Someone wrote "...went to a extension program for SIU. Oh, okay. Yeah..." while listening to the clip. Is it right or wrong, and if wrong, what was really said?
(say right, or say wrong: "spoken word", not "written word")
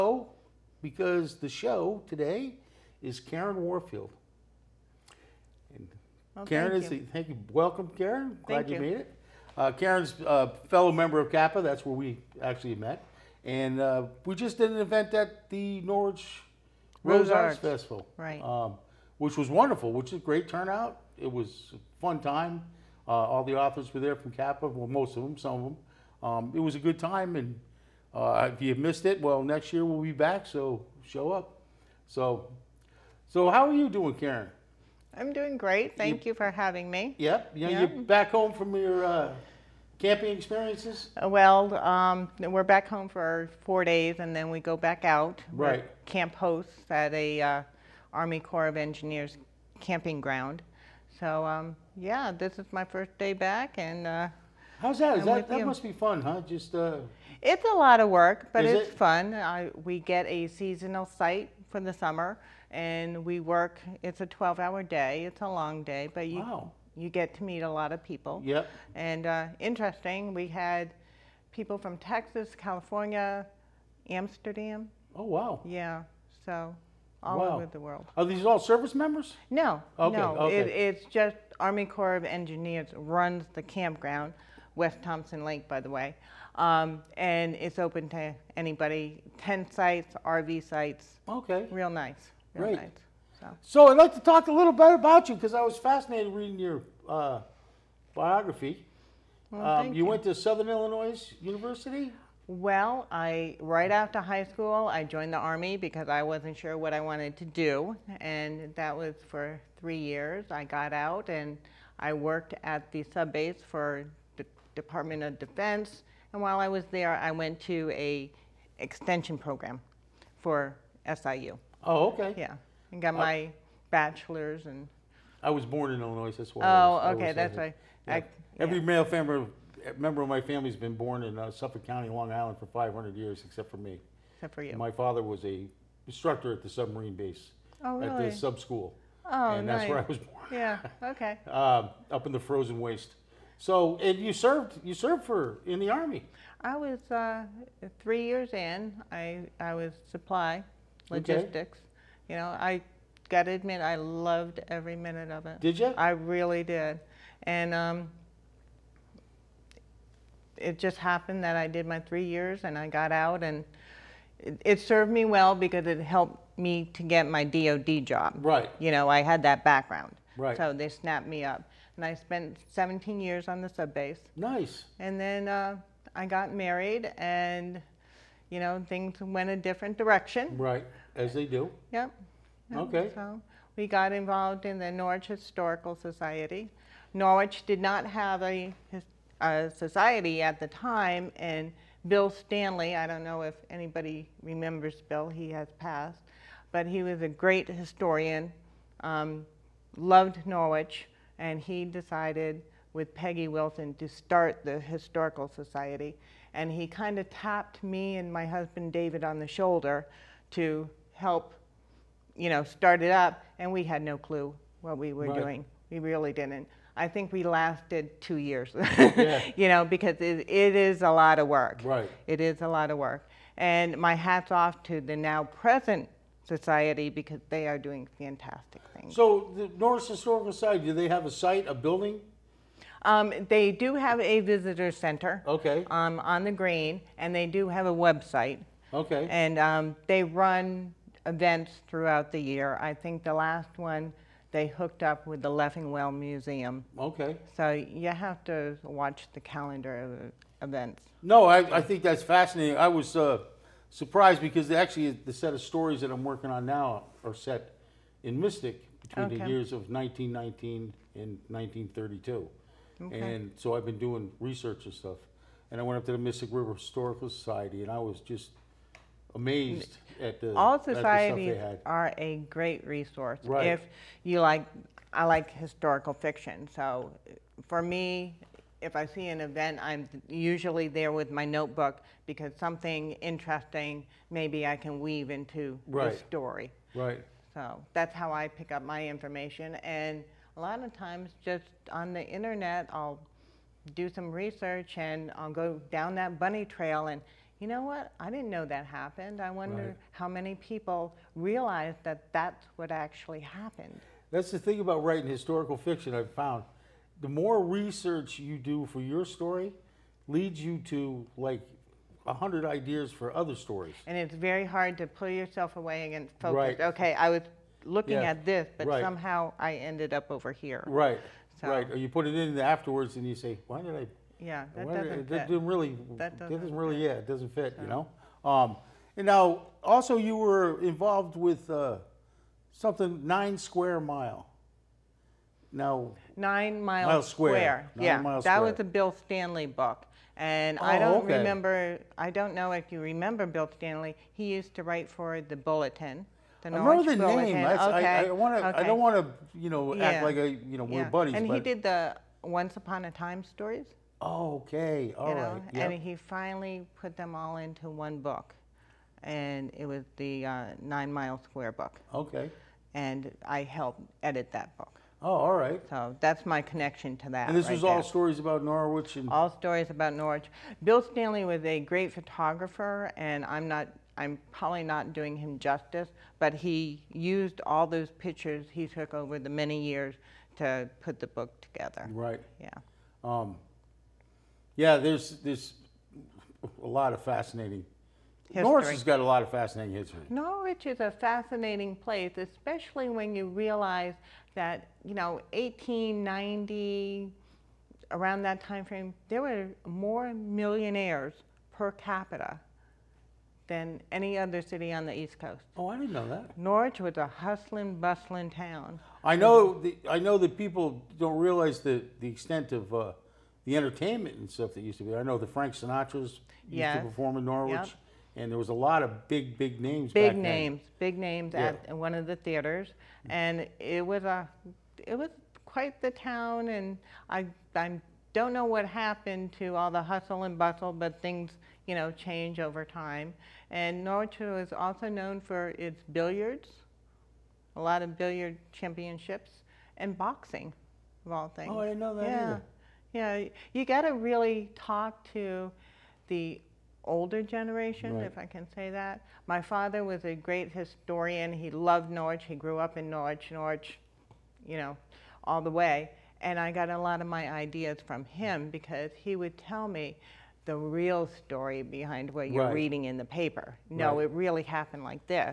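right.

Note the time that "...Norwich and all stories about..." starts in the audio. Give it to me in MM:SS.
06:08.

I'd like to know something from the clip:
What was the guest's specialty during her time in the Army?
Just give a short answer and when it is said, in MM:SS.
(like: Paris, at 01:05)
supply, logistics, at 02:30.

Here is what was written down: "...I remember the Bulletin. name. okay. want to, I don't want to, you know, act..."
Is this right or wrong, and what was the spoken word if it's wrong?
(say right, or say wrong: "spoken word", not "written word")
right.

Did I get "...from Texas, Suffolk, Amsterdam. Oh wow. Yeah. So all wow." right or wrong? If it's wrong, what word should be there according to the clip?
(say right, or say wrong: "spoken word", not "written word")
wrong: "California", not "Suffolk".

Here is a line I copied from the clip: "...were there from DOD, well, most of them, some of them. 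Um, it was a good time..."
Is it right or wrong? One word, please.
wrong.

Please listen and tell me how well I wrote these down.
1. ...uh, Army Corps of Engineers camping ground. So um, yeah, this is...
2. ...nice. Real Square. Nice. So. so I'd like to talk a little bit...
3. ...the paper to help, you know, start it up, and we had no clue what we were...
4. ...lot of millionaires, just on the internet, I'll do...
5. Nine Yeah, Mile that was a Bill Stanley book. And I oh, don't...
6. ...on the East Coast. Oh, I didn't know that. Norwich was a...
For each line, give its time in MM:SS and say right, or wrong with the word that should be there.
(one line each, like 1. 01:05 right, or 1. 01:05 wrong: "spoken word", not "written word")
1. 00:47 right
2. 01:31 wrong: "Great", not "Square"
3. 03:29 wrong: "shoulder", not "paper"
4. 04:50 wrong: "times", not "millionaires"
5. 05:37 right
6. 06:44 right.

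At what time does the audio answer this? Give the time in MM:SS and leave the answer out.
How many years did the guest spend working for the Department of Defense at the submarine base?
02:52.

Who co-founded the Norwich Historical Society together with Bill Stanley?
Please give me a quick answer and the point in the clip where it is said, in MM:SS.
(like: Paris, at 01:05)
Peggy Wilson, at 03:23.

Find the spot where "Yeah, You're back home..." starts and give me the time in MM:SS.
00:37.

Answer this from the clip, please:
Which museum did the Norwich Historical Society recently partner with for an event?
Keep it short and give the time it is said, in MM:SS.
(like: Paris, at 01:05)
Leffingwell Museum, at 04:05.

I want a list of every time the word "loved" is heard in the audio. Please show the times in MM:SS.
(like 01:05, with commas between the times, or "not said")
02:33, 03:19, 07:31.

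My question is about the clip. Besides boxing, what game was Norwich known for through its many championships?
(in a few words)
billiards.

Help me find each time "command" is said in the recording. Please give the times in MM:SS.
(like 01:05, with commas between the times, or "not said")
not said.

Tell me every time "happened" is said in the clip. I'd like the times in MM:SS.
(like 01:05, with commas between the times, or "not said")
02:40, 04:58, 05:03, 07:08, 07:44.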